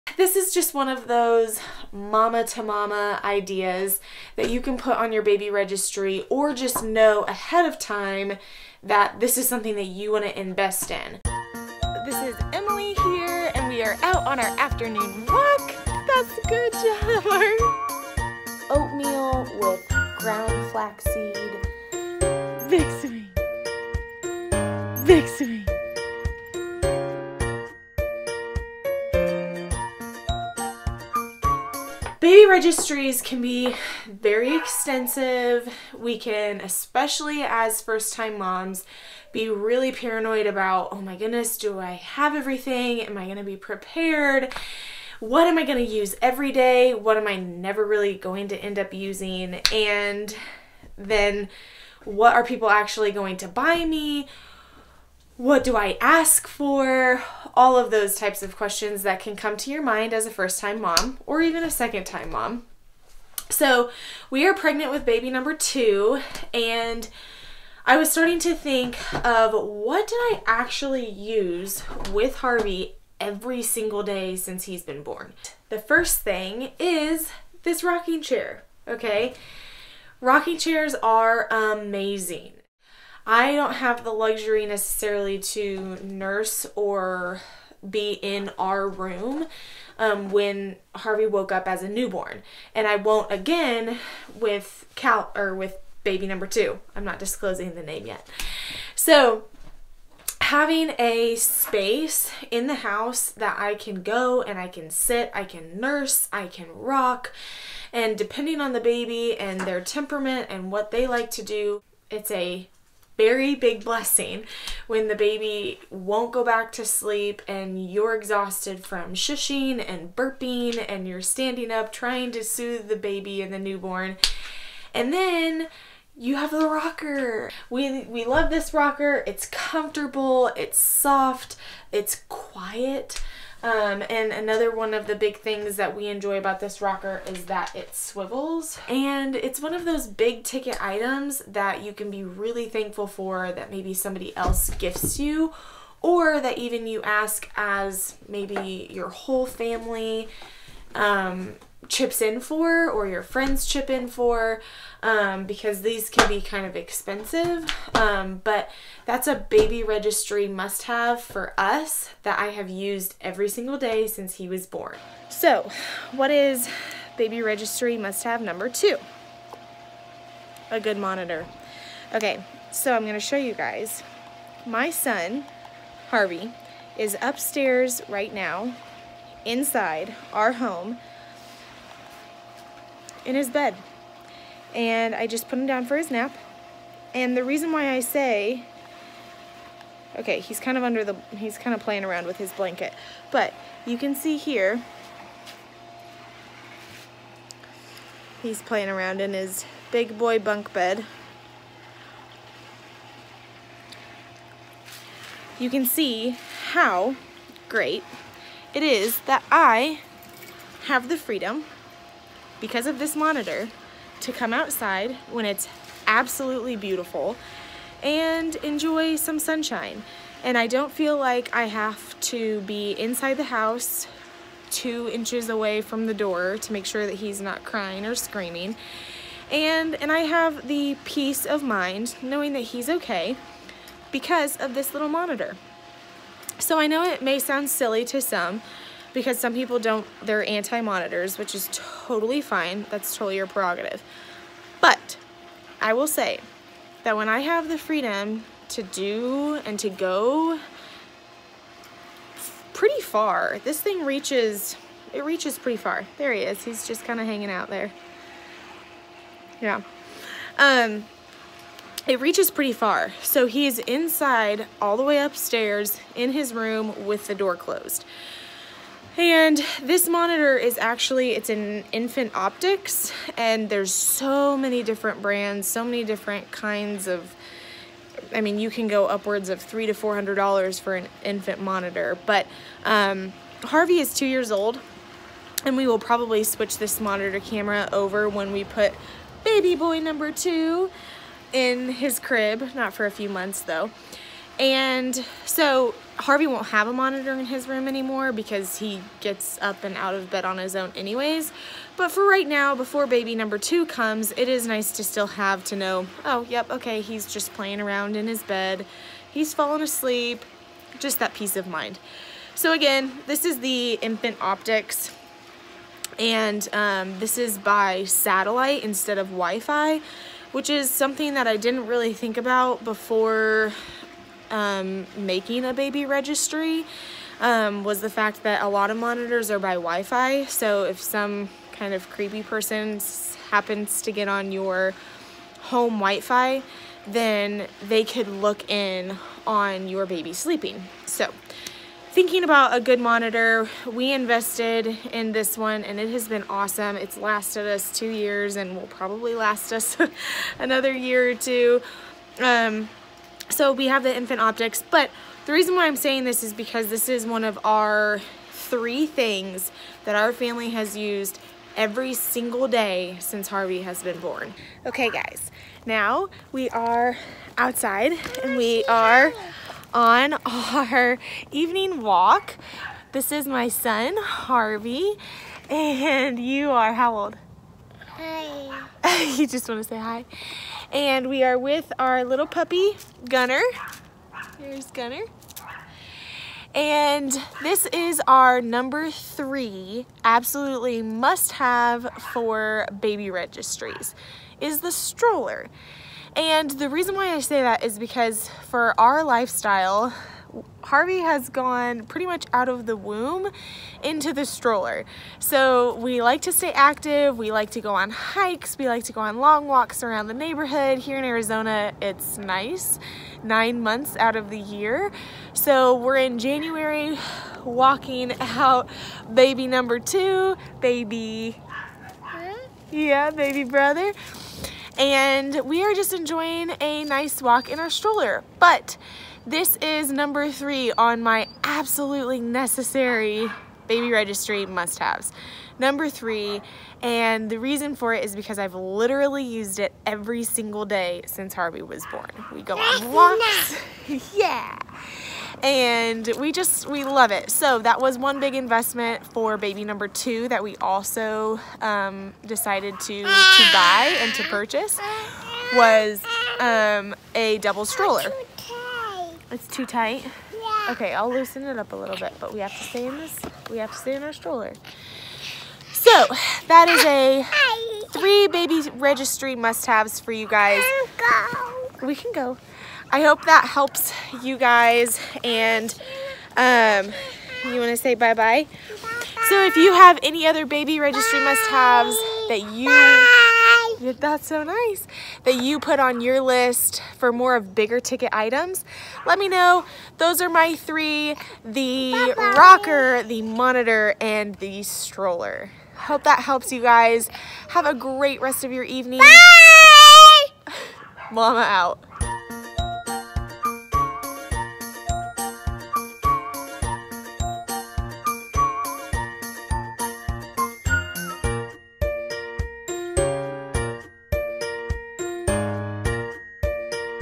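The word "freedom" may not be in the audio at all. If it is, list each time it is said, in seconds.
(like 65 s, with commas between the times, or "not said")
211 s, 247 s.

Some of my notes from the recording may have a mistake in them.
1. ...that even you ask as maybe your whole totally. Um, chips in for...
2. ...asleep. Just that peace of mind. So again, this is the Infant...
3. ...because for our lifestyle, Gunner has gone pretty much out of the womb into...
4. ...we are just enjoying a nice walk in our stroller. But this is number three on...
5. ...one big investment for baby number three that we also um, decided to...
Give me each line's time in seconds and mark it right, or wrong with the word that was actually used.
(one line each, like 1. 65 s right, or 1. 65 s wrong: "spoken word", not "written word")
1. 146 s wrong: "family", not "totally"
2. 309 s right
3. 397 s wrong: "Harvey", not "Gunner"
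4. 425 s right
5. 448 s wrong: "two", not "three".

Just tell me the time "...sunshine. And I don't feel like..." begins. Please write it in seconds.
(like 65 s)
219 s.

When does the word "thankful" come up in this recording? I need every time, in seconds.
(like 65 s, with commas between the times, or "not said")
142 s.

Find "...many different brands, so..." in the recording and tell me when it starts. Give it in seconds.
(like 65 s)
274 s.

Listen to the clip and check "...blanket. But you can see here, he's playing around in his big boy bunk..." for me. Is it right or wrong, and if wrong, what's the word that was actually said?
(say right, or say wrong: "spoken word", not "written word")
right.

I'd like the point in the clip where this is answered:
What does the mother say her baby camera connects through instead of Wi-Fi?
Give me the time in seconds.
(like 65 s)
318 s.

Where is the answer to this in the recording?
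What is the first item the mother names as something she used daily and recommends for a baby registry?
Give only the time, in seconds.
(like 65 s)
77 s.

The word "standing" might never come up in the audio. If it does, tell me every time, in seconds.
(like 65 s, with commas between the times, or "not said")
121 s.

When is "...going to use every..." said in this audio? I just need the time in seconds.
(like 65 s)
45 s.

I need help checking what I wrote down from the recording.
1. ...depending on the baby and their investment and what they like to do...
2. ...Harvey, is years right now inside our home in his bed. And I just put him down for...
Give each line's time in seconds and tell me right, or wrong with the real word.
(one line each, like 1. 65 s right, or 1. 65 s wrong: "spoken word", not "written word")
1. 108 s wrong: "temperament", not "investment"
2. 176 s wrong: "upstairs", not "years".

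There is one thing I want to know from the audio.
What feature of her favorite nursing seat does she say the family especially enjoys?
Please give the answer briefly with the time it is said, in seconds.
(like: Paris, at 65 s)
It swivels, at 137 s.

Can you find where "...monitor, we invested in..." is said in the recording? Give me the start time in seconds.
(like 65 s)
342 s.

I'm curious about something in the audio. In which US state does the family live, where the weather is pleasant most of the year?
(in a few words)
Arizona.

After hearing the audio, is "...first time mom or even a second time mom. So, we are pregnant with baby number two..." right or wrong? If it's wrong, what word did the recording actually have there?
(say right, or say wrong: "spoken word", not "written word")
right.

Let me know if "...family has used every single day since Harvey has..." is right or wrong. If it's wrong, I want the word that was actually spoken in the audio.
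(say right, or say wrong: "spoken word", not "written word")
right.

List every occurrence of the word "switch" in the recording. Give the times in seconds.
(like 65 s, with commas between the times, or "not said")
286 s.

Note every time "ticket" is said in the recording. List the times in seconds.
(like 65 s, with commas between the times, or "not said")
140 s, 487 s.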